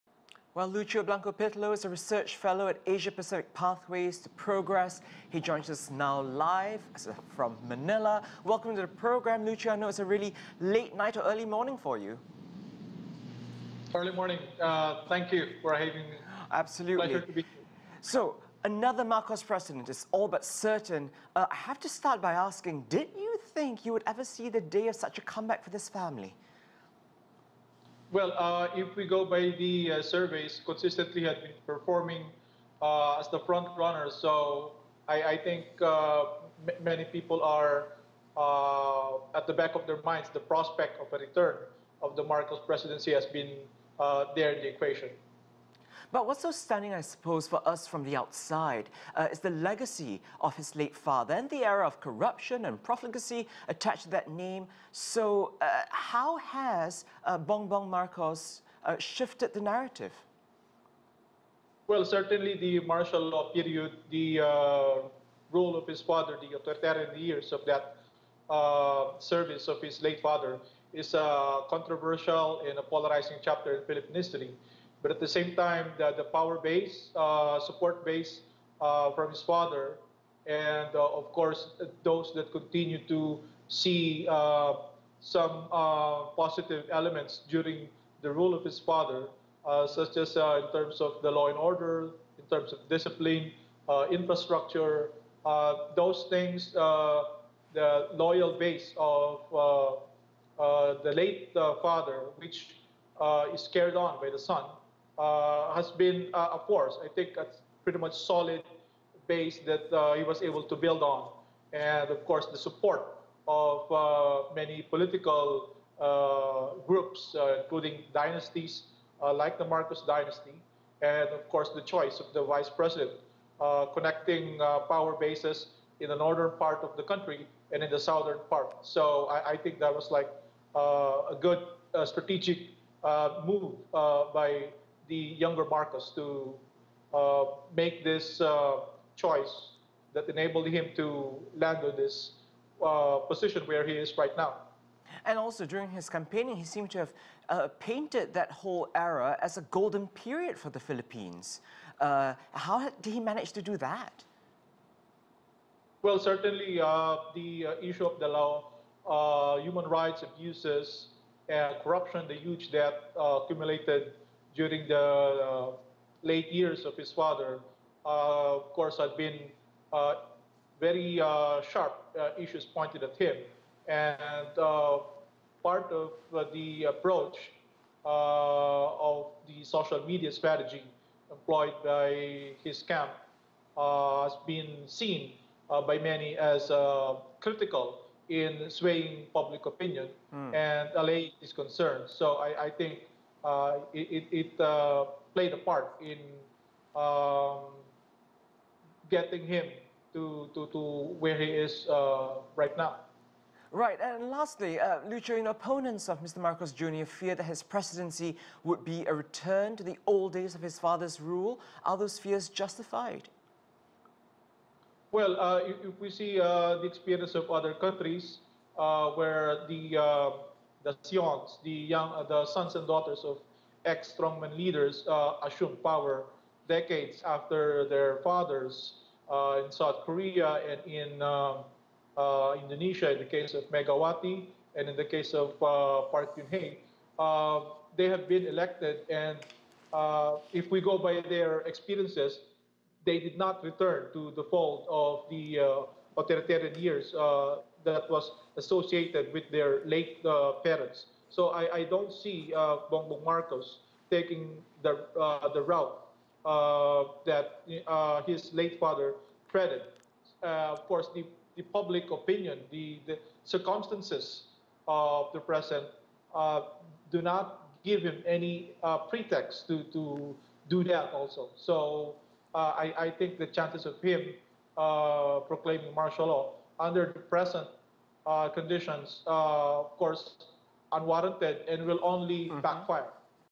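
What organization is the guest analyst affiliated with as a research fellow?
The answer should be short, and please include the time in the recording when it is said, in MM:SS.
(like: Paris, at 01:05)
Asia Pacific Pathways to Progress, at 00:02.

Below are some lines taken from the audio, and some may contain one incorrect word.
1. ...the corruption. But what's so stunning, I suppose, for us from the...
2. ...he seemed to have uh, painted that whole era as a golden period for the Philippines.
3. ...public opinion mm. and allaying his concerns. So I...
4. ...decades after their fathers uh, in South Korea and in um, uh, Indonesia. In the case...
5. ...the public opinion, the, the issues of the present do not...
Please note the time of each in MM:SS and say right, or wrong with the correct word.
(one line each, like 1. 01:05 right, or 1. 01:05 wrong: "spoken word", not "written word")
1. 00:44 wrong: "equation", not "corruption"
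2. 02:26 right
3. 03:09 right
4. 03:46 right
5. 04:21 wrong: "circumstances", not "issues".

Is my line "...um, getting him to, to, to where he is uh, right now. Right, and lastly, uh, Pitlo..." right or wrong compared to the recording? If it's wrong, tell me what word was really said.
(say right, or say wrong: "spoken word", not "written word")
wrong: "Lucho", not "Pitlo".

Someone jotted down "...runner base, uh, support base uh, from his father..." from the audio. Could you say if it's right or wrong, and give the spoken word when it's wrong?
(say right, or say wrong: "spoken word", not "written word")
wrong: "power", not "runner".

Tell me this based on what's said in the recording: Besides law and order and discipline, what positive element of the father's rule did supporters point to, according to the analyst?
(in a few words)
infrastructure.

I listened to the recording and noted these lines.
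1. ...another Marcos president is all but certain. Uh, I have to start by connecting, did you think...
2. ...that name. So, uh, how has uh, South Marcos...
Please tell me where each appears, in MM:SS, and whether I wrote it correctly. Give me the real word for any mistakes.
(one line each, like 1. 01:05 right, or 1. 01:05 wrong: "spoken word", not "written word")
1. 00:18 wrong: "asking", not "connecting"
2. 00:54 wrong: "Bongbong", not "South".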